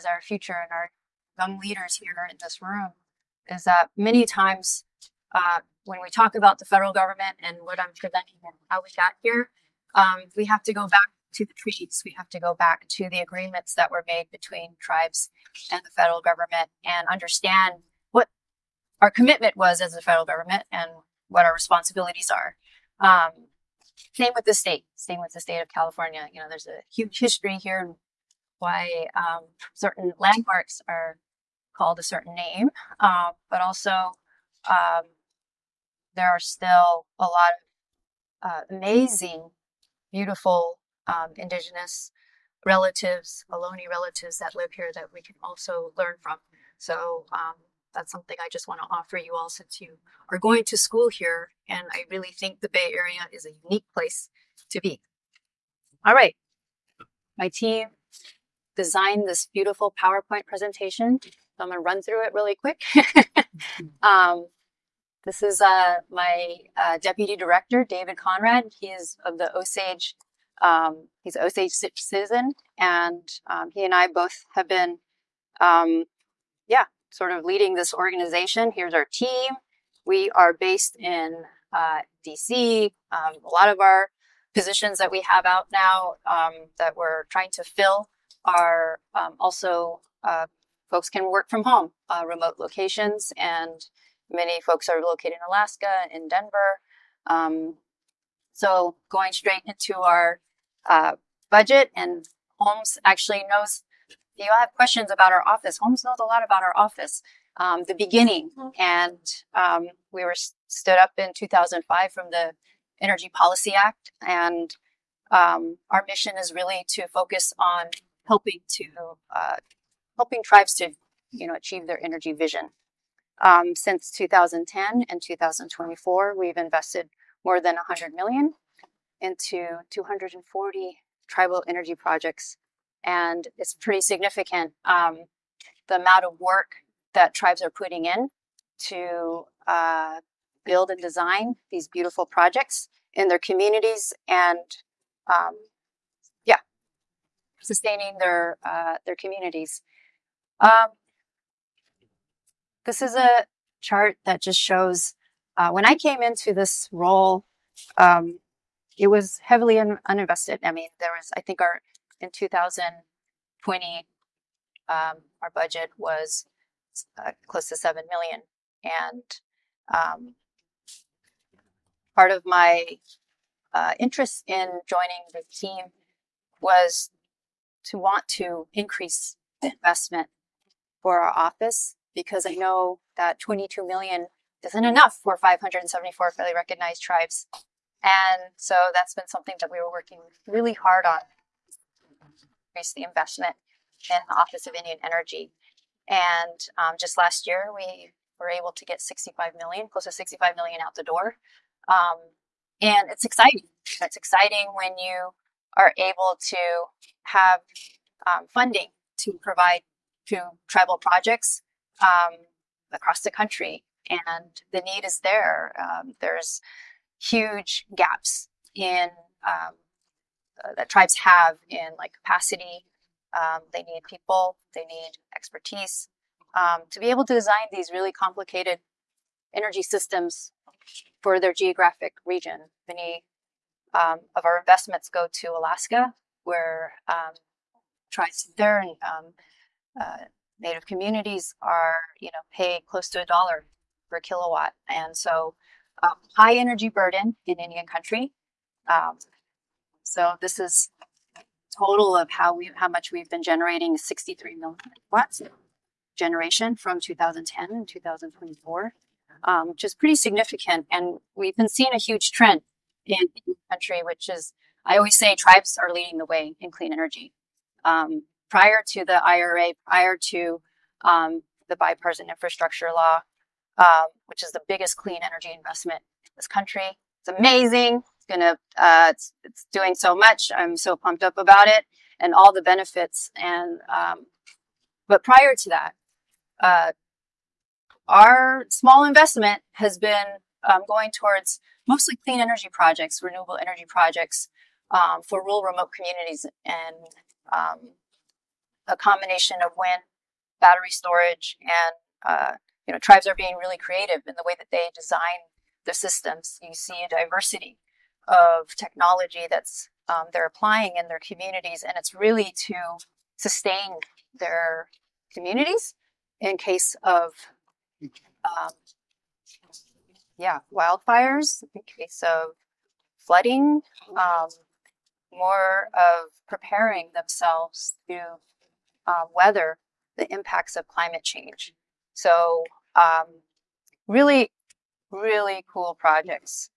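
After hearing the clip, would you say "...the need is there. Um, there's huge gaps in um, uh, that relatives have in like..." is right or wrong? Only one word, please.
wrong.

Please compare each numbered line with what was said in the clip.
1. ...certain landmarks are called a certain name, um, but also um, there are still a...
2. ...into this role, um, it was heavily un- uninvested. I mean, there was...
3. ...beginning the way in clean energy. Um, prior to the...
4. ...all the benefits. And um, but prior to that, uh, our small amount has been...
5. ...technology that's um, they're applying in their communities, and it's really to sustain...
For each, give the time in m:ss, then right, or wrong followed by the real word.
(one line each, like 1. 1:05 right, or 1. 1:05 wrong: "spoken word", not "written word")
1. 0:29 right
2. 2:36 right
3. 4:25 wrong: "leading", not "beginning"
4. 4:42 wrong: "investment", not "amount"
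5. 5:08 right.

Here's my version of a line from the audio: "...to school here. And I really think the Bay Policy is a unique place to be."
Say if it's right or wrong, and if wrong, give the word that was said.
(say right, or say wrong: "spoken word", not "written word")
wrong: "Area", not "Policy".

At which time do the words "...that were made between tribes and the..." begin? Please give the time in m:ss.
0:13.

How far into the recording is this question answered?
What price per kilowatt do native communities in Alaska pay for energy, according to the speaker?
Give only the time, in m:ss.
4:03.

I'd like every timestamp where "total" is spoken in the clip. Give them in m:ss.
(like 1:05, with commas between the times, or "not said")
4:11.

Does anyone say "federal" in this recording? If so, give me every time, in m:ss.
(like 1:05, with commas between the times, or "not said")
0:06, 0:15, 0:20.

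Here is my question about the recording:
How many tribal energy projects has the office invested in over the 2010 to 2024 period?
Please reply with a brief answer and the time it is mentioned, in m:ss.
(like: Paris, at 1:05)
240, at 2:09.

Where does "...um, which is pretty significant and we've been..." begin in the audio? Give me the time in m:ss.
4:19.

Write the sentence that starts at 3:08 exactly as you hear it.
And so that's been something that we were working really hard on increase the investment in the Office of Indian Energy.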